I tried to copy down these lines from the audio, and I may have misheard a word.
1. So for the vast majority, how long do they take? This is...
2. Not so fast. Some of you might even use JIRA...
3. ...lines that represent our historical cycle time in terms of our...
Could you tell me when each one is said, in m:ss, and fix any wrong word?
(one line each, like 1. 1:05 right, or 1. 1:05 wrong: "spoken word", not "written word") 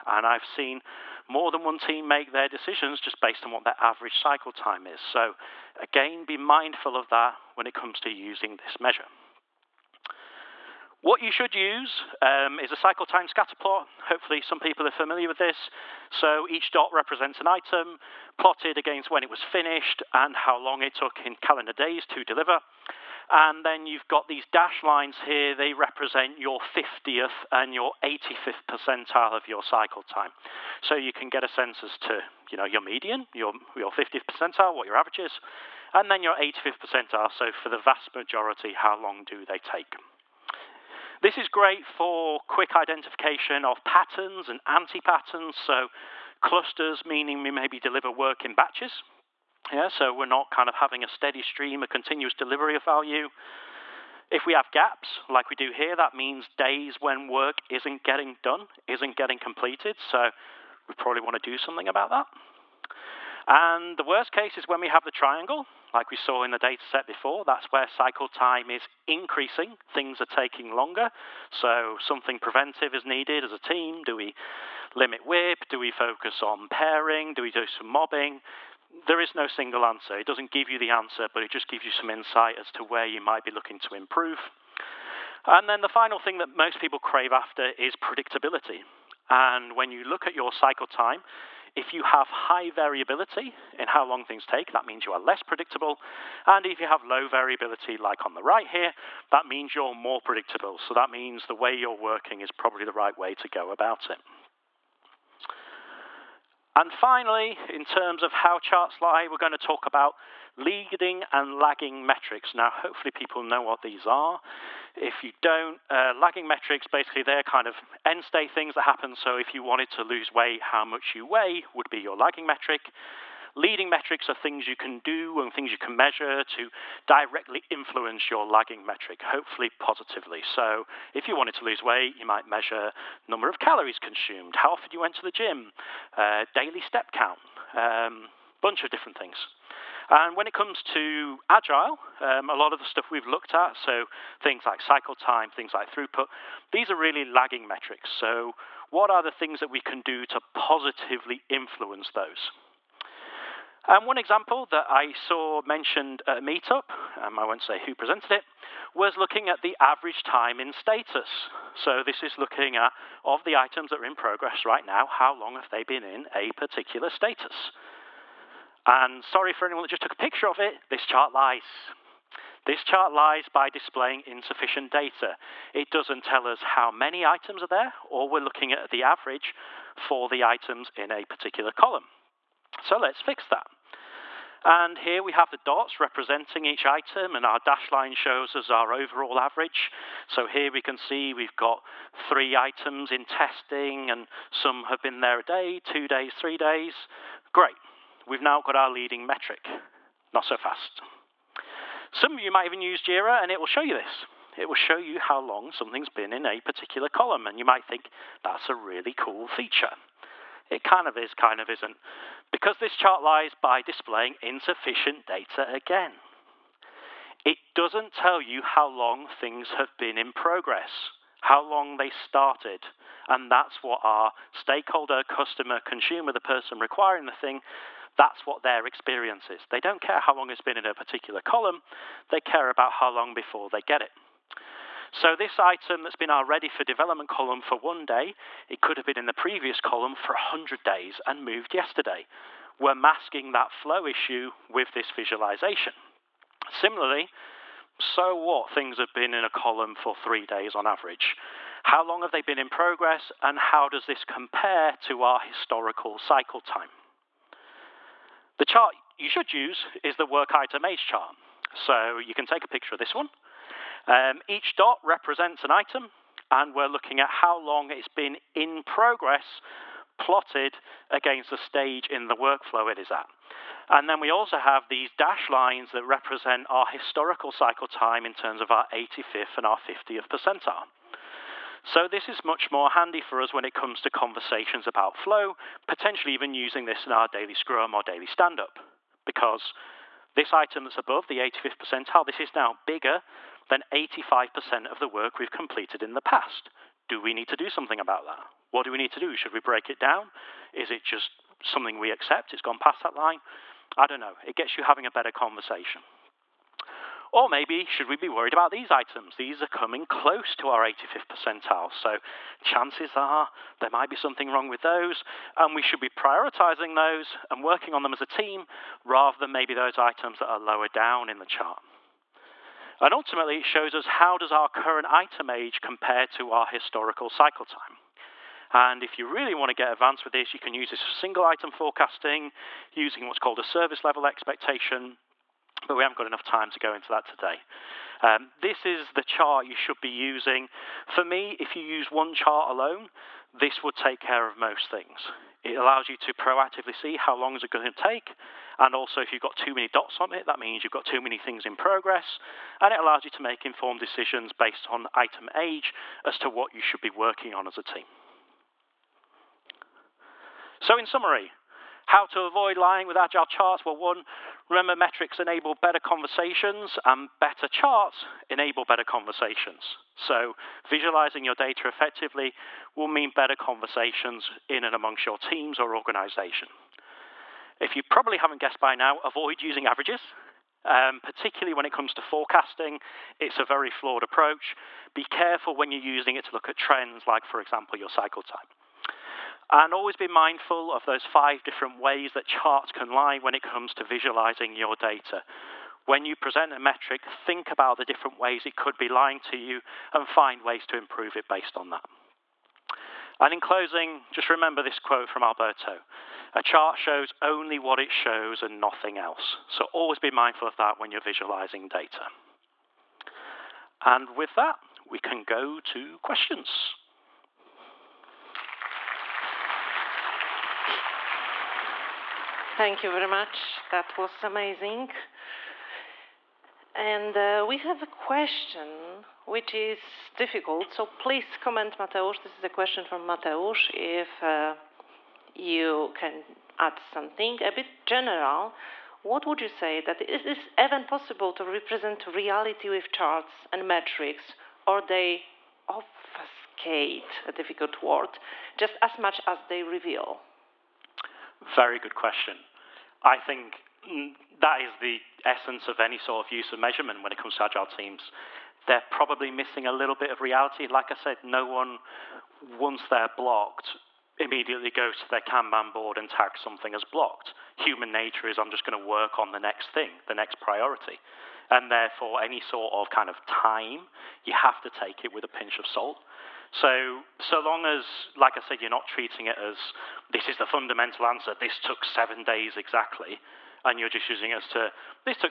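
1. 0:37 right
2. 3:20 right
3. 4:35 right.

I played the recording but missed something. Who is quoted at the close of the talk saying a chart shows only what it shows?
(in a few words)
Alberto.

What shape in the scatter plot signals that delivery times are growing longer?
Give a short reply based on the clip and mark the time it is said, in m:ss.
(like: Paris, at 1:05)
triangle, at 1:05.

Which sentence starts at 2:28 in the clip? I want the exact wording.
So what are the things that we can do to positively influence those?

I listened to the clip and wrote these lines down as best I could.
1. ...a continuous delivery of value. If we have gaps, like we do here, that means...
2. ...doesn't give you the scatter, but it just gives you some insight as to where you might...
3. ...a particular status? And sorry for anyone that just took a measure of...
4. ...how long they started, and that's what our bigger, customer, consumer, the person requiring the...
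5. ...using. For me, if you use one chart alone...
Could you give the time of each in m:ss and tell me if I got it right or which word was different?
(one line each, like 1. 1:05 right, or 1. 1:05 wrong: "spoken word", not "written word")
1. 0:51 right
2. 1:20 wrong: "answer", not "scatter"
3. 2:46 wrong: "picture", not "measure"
4. 3:41 wrong: "stakeholder", not "bigger"
5. 5:40 right.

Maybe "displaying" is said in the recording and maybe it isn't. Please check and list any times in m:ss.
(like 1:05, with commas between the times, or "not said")
2:53, 3:33.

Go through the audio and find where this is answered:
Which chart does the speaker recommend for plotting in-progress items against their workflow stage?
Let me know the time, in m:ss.
4:20.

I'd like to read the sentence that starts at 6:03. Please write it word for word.
Well, one, remember metrics enable better conversations, and better charts enable better conversations.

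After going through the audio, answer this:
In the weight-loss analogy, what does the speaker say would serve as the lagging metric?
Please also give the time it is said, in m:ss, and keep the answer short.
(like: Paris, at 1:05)
how much you weigh, at 2:00.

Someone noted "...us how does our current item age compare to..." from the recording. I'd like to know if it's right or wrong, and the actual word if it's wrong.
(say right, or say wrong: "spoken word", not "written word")
right.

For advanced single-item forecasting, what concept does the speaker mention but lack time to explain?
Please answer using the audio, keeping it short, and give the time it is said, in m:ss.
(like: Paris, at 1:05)
service level expectation, at 5:33.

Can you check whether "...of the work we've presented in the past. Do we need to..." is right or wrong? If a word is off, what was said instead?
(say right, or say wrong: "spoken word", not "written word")
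wrong: "completed", not "presented".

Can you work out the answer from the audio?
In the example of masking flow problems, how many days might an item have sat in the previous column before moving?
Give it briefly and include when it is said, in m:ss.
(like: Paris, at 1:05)
100, at 4:00.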